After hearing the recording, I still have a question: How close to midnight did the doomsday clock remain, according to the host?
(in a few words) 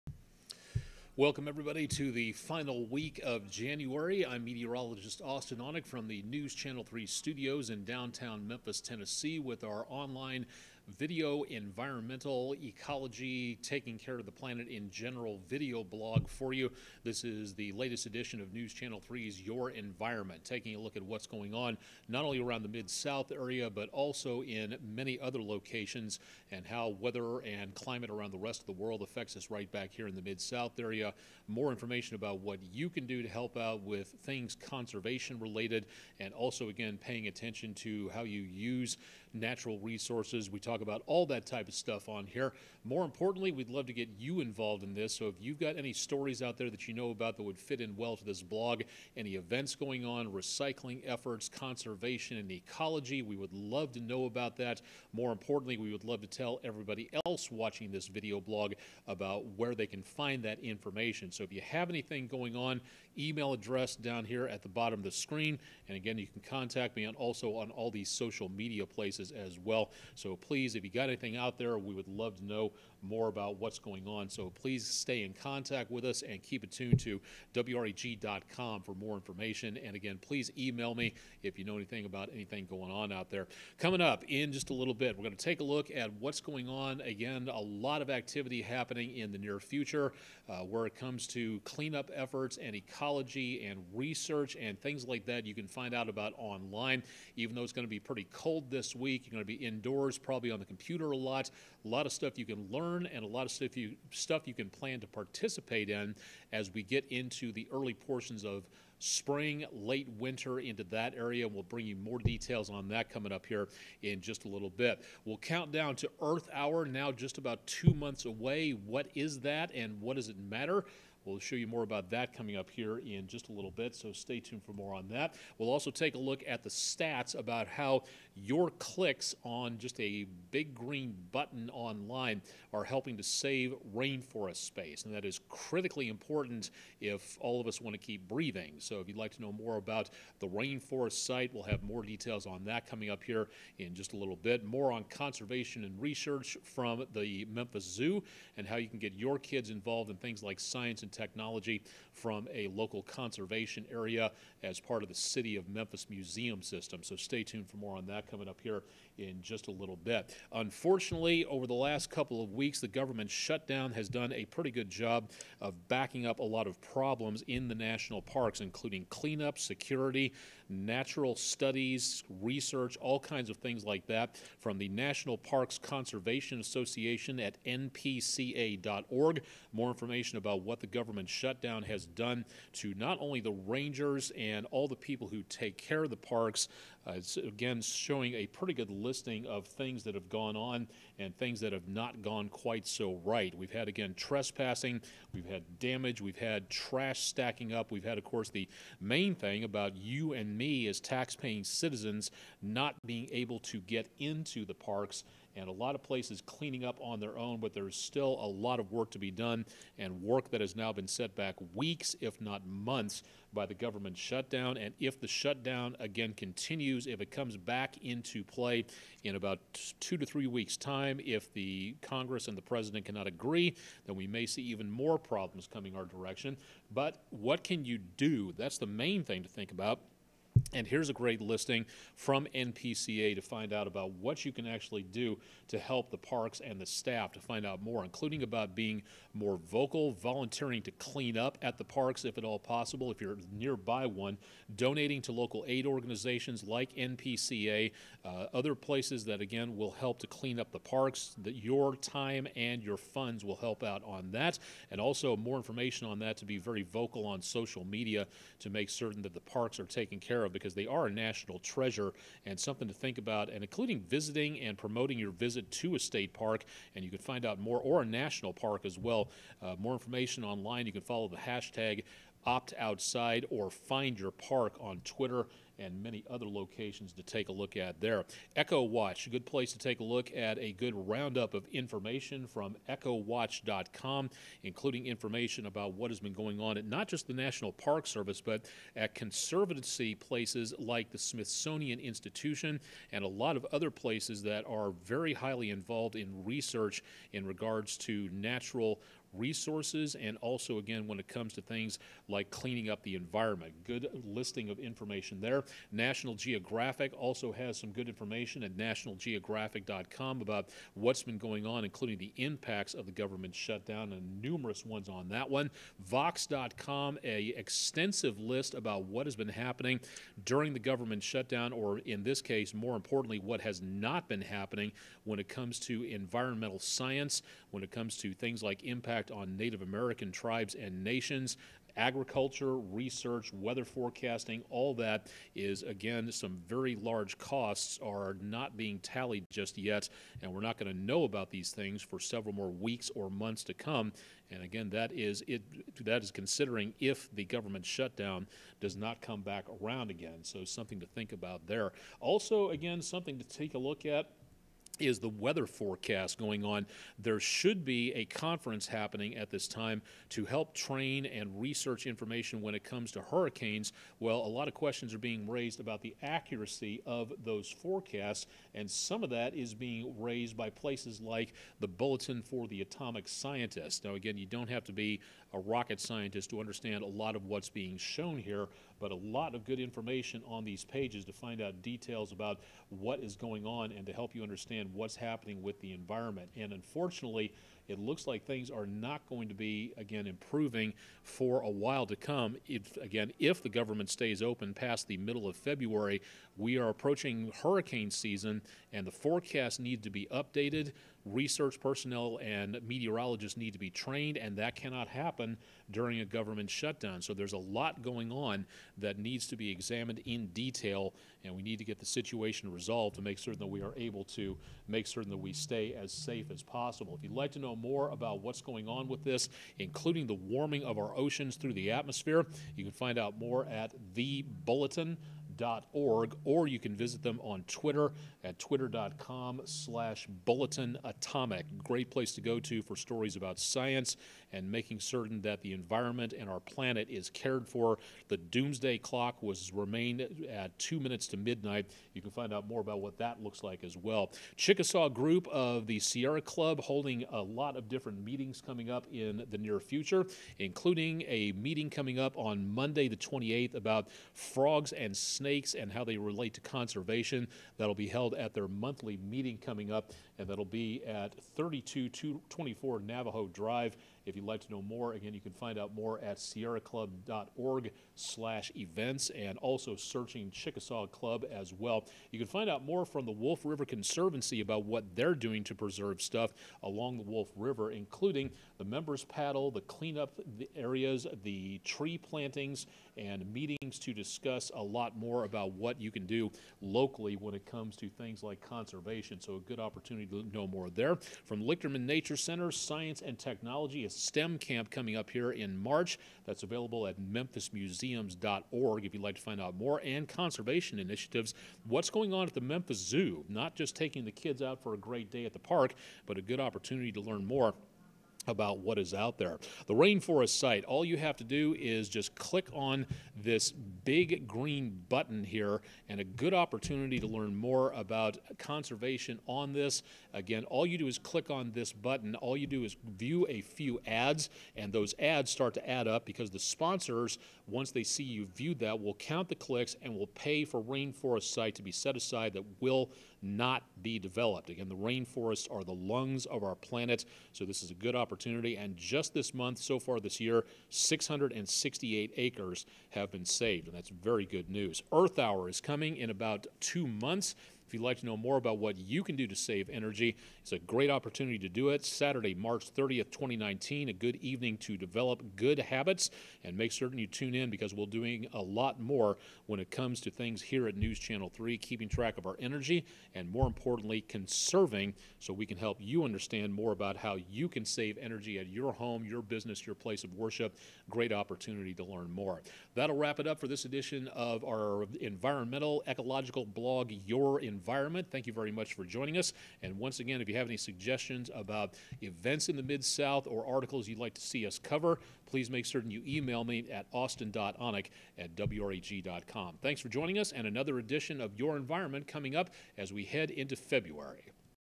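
2 minutes.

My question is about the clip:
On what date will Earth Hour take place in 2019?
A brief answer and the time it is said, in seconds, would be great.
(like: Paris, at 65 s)
Saturday, March 30th, at 552 s.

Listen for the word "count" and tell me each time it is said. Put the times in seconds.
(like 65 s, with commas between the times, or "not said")
115 s, 529 s.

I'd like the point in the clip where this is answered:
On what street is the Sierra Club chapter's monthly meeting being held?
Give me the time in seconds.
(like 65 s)
463 s.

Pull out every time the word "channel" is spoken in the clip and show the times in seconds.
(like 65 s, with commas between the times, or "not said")
6 s, 18 s, 561 s.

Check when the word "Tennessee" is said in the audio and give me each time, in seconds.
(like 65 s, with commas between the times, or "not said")
8 s.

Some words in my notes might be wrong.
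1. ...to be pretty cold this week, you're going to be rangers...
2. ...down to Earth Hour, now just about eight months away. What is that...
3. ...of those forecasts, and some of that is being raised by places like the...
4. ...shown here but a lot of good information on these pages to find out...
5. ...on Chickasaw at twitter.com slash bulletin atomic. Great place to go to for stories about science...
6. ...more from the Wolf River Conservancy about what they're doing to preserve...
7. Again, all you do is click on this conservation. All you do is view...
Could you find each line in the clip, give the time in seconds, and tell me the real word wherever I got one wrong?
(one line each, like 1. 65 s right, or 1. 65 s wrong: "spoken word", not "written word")
1. 97 s wrong: "indoors", not "rangers"
2. 115 s wrong: "two", not "eight"
3. 367 s right
4. 377 s right
5. 427 s wrong: "Twitter", not "Chickasaw"
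6. 472 s right
7. 520 s wrong: "button", not "conservation".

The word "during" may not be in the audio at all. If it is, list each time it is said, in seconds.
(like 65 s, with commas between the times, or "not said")
320 s, 405 s.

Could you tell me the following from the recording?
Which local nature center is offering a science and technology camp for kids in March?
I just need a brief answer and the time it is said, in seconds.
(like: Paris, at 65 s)
Lichterman Nature Center, at 491 s.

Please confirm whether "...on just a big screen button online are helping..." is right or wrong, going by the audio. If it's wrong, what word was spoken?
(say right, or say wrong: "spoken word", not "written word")
wrong: "green", not "screen".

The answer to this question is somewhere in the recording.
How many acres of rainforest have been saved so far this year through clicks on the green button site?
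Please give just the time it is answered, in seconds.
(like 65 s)
540 s.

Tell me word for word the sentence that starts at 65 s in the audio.
And again, you can contact me on also on all these social media places as well.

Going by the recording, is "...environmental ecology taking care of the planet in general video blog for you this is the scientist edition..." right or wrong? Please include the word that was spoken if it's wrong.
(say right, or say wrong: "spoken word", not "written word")
wrong: "latest", not "scientist".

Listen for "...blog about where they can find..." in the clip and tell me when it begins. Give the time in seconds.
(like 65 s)
58 s.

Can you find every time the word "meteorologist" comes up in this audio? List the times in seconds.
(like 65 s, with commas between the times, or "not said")
4 s, 402 s.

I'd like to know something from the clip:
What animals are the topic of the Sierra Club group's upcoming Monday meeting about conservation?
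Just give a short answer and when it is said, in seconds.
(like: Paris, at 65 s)
frogs and snakes, at 454 s.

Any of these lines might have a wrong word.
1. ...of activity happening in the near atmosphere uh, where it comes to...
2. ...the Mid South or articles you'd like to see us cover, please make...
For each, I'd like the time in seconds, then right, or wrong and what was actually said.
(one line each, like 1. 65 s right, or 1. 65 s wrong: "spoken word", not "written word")
1. 88 s wrong: "future", not "atmosphere"
2. 582 s right.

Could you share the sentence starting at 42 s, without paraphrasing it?
More importantly, we'd love to get you involved in this.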